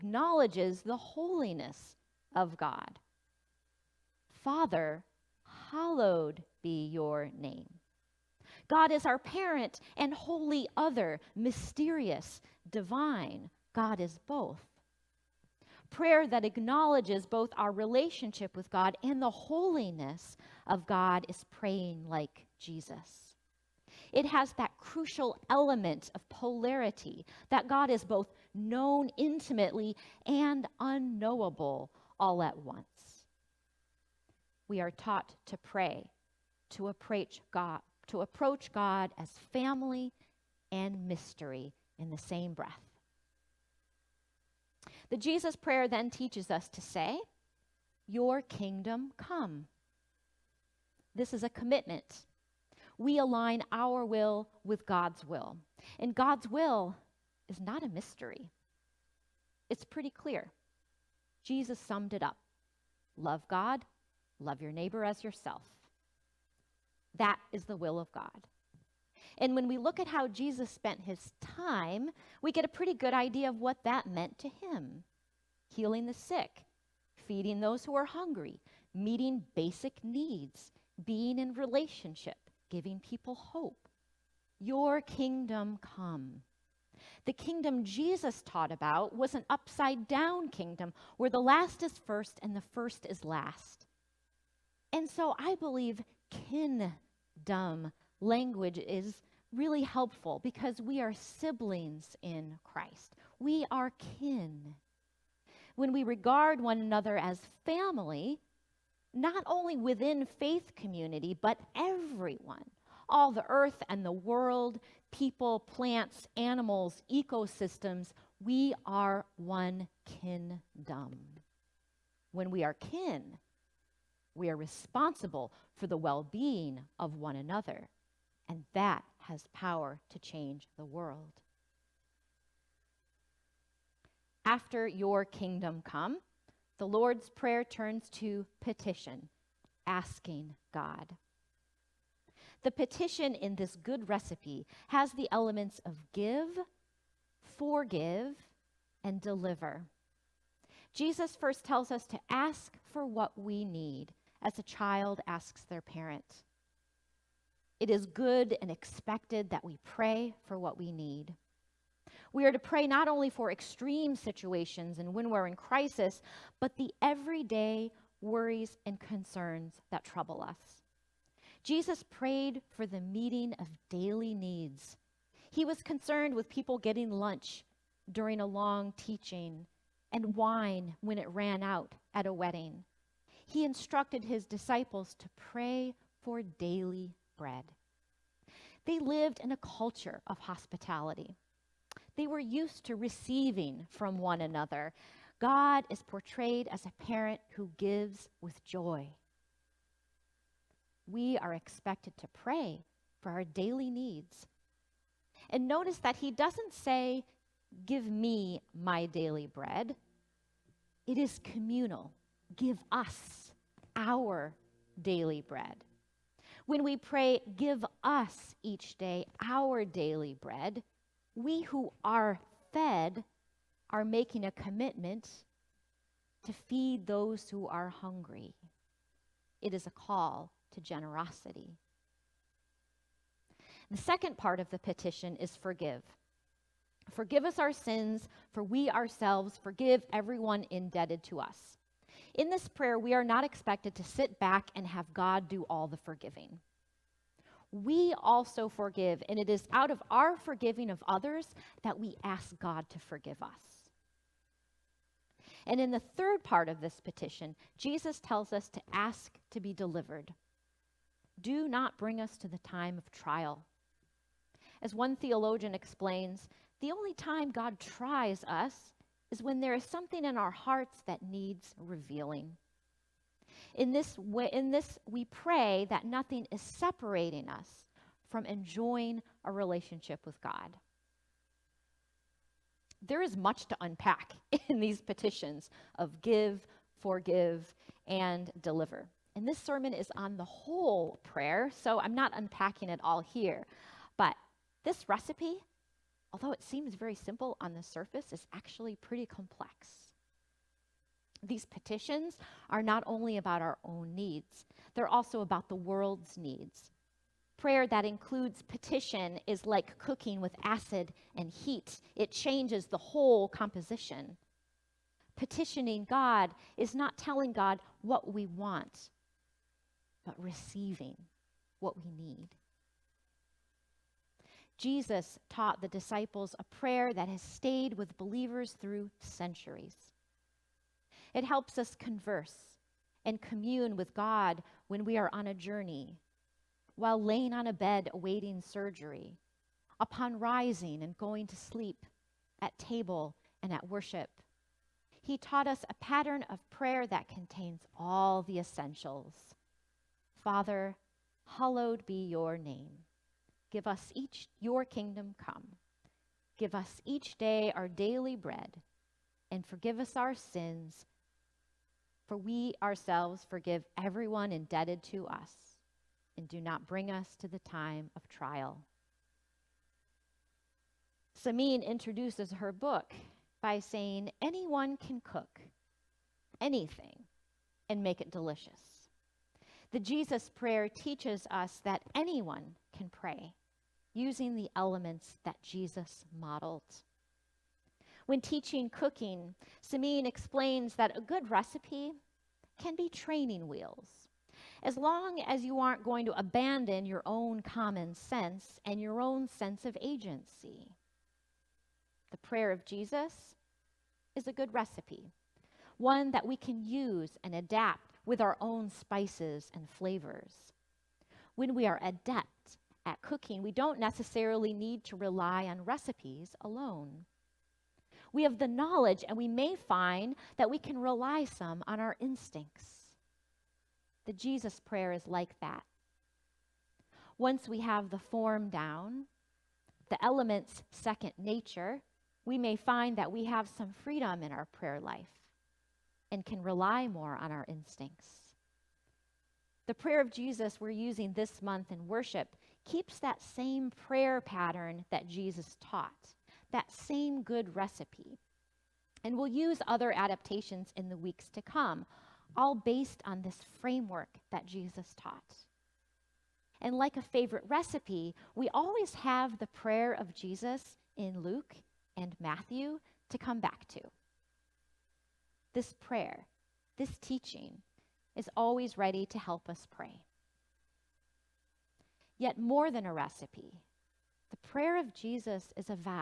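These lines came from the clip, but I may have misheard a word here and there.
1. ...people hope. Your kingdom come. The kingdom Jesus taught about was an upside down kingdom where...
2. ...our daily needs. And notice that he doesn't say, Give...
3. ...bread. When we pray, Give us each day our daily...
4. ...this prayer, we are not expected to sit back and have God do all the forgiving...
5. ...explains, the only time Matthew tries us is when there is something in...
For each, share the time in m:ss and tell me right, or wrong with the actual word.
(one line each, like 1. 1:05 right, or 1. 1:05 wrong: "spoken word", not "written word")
1. 1:22 right
2. 3:23 right
3. 3:35 right
4. 4:02 right
5. 4:25 wrong: "God", not "Matthew".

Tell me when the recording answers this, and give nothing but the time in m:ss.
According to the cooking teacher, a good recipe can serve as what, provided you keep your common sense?
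6:33.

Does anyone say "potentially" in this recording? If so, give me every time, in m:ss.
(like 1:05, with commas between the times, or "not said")
not said.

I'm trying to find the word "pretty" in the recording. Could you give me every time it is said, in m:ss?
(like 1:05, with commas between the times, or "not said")
0:59, 1:12, 4:58.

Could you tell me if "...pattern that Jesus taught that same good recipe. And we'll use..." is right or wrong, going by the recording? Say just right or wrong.
right.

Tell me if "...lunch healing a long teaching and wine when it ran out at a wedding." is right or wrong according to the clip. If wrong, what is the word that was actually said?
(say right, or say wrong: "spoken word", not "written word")
wrong: "during", not "healing".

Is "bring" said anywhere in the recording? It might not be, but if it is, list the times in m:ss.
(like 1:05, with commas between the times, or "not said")
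4:21, 6:06.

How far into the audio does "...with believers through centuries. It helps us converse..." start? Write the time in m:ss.
5:27.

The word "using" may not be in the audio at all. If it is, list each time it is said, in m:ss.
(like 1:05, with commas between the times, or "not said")
6:24, 7:20.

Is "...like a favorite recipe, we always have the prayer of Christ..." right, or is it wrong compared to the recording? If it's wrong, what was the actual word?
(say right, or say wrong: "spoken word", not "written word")
wrong: "Jesus", not "Christ".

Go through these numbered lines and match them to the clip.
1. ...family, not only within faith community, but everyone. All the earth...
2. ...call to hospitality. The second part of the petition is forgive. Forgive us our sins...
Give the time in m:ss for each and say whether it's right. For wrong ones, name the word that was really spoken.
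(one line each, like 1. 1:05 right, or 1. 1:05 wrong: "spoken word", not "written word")
1. 1:47 right
2. 3:49 wrong: "generosity", not "hospitality".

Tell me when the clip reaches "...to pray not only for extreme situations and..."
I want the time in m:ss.
2:42.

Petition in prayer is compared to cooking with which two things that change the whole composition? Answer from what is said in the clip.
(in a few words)
Acid and heat.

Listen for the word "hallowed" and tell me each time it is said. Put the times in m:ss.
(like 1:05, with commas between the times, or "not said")
0:05, 5:51.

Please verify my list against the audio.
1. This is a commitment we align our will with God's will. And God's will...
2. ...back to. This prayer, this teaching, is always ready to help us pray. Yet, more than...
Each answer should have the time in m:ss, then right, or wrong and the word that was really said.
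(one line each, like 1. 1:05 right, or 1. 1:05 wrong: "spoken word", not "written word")
1. 0:51 right
2. 7:43 right.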